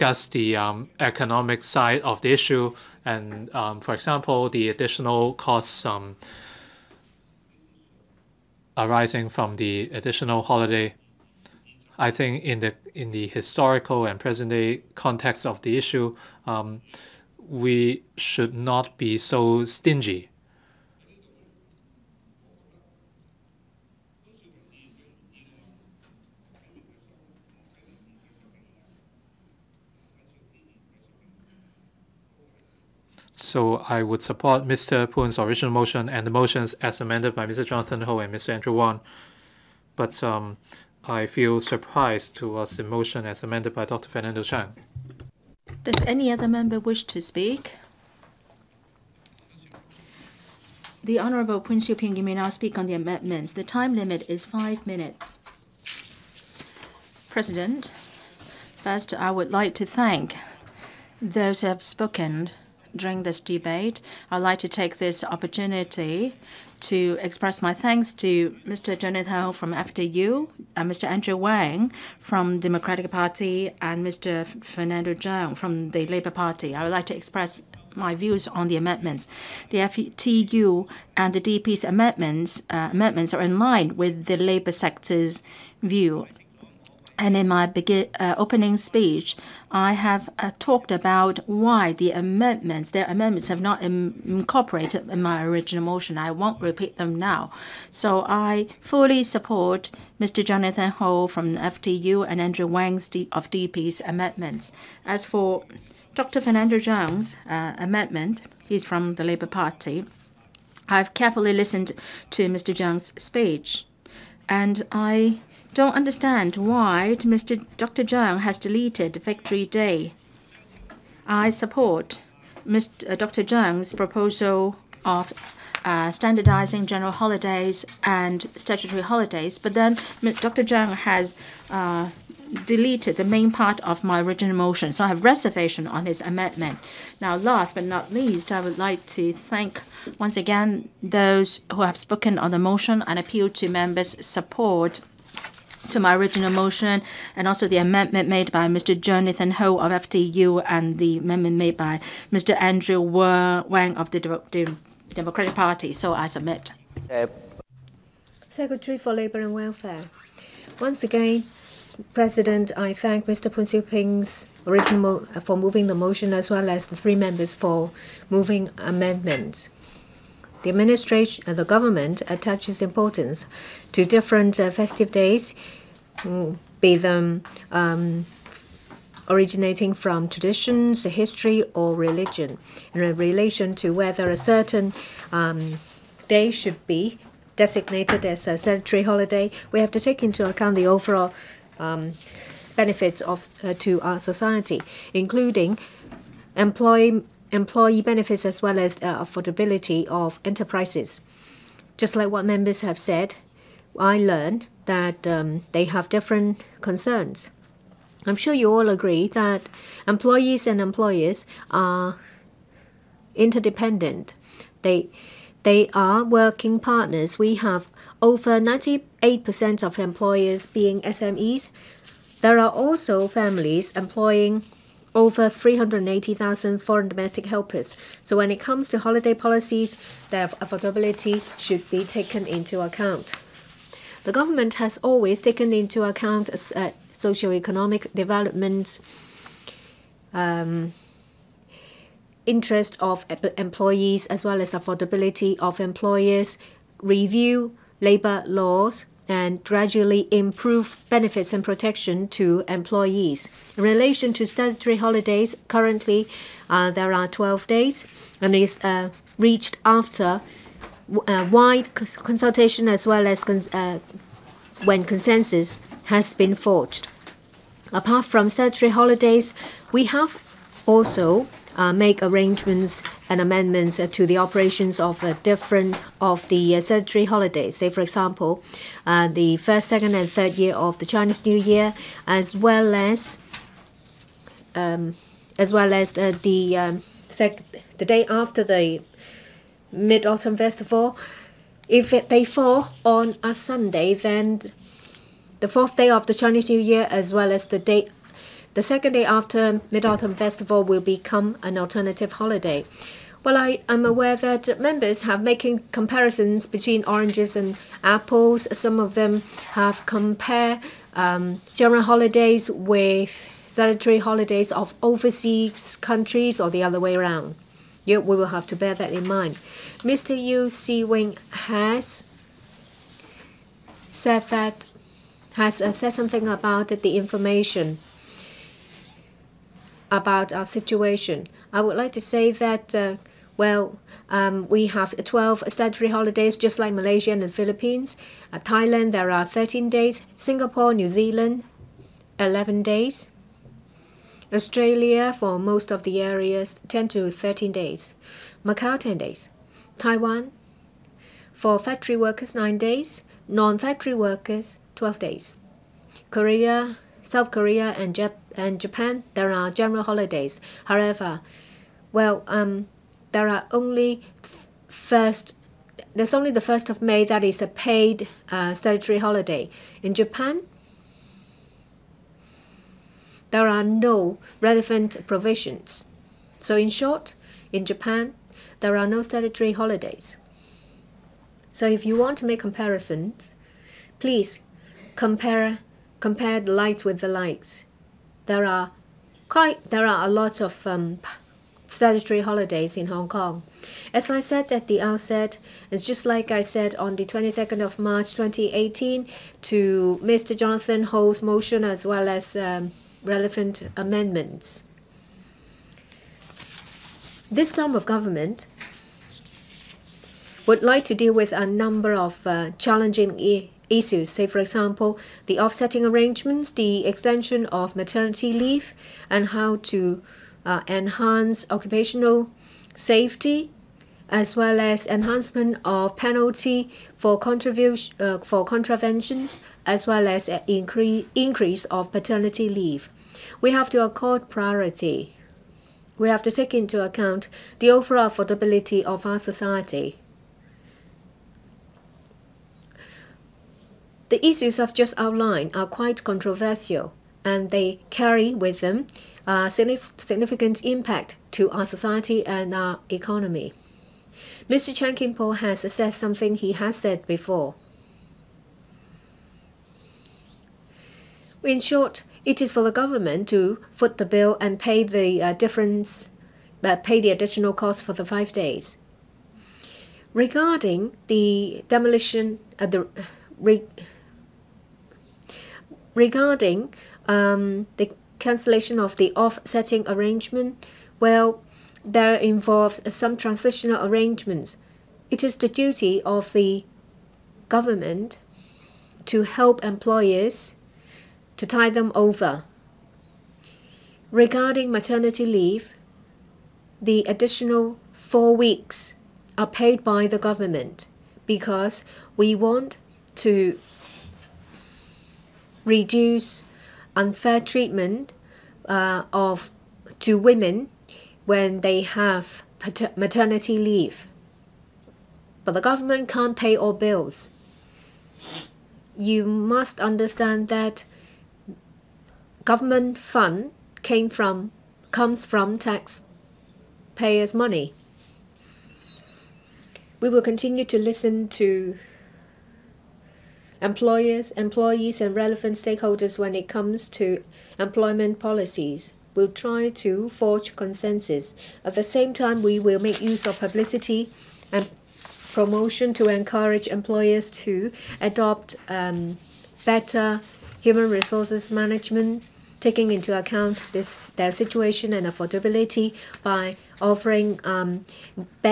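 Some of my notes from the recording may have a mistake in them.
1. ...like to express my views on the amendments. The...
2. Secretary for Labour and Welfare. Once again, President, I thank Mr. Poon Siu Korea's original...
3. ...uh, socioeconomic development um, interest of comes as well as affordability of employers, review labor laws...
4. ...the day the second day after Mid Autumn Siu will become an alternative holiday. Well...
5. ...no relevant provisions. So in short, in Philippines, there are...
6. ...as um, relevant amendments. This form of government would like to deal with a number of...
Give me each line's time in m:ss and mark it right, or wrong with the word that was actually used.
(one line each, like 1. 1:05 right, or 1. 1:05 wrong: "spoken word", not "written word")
1. 1:16 right
2. 2:38 wrong: "Ping", not "Korea"
3. 3:56 wrong: "employees", not "comes"
4. 4:57 wrong: "Festival", not "Siu"
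5. 6:13 wrong: "Japan", not "Philippines"
6. 6:42 right.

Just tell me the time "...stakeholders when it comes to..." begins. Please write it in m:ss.
8:55.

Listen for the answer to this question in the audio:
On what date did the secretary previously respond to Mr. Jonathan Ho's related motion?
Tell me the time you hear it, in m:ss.
6:37.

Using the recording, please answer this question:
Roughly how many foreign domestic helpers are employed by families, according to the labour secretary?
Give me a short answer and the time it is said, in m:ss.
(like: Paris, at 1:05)
380,000, at 3:45.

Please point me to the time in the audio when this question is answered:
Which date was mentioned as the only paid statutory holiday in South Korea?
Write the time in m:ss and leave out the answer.
6:06.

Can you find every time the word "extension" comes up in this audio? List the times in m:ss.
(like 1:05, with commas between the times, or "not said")
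6:57.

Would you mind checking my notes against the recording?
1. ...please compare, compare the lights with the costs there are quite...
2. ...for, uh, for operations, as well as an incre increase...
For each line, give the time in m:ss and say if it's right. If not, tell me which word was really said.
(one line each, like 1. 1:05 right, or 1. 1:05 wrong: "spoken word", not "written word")
1. 6:24 wrong: "lights", not "costs"
2. 7:07 wrong: "contraventions", not "operations".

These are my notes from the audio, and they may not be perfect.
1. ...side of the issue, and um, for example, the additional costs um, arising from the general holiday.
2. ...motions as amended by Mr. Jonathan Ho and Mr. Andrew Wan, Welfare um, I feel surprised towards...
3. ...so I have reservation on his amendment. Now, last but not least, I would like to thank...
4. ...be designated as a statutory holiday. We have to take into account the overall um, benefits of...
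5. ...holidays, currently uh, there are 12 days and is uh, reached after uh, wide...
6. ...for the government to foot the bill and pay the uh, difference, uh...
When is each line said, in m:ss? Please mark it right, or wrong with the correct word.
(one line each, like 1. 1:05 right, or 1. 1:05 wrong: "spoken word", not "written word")
1. 0:01 wrong: "additional", not "general"
2. 0:36 wrong: "But", not "Welfare"
3. 2:14 right
4. 3:06 right
5. 4:14 right
6. 7:42 right.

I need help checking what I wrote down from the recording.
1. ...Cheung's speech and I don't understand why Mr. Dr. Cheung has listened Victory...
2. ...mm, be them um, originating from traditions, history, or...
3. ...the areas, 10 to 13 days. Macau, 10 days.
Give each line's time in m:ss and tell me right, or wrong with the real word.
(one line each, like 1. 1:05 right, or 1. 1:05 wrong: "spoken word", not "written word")
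1. 1:52 wrong: "deleted", not "listened"
2. 2:56 right
3. 5:46 right.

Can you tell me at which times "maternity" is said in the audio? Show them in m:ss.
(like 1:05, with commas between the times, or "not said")
6:57, 8:14, 8:33.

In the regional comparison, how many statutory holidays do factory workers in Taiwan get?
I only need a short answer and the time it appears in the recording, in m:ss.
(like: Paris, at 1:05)
9, at 5:52.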